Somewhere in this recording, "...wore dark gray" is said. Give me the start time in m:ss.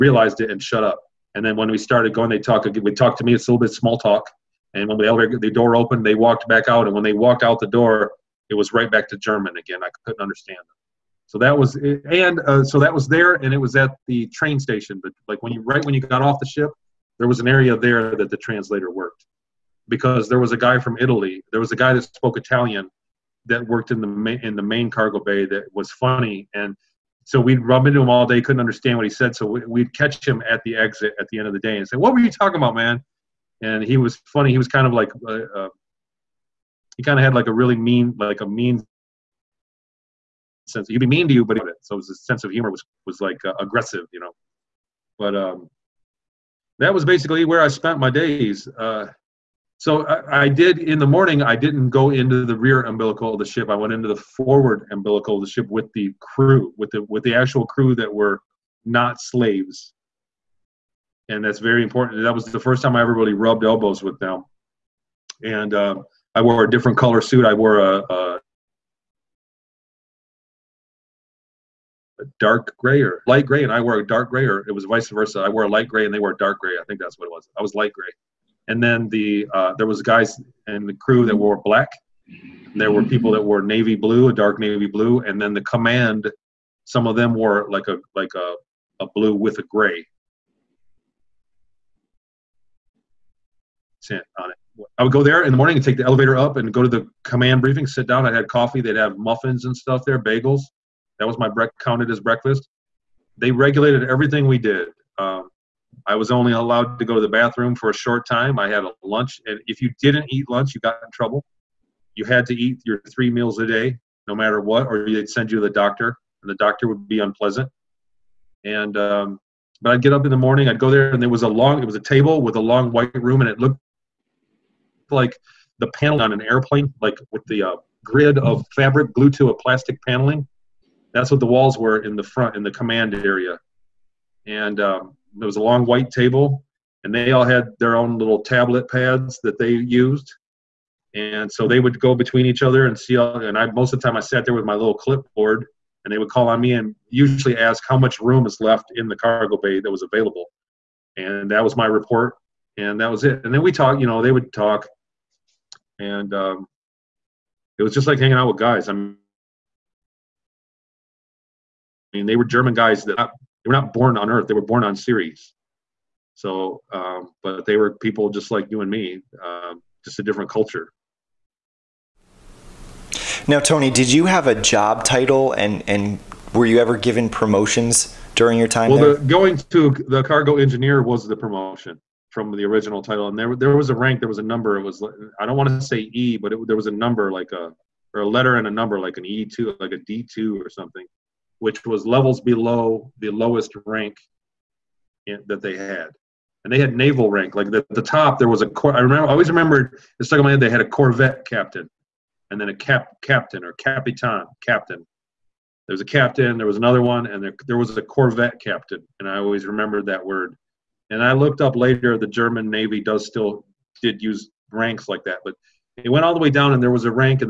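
1:16.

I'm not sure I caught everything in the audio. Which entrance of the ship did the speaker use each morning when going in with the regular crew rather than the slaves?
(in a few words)
forward umbilical.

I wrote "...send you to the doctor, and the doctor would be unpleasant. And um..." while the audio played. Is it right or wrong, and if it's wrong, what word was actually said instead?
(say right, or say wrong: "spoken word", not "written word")
right.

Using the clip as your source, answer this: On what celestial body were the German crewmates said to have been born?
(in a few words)
Ceres.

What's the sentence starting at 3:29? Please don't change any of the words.
And I always remembered that word.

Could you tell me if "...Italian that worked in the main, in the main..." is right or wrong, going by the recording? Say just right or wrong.
right.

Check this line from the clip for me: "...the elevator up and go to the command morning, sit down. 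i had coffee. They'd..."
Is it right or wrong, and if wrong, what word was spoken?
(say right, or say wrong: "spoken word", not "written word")
wrong: "briefing", not "morning".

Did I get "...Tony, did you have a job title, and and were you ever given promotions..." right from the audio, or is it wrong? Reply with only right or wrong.
right.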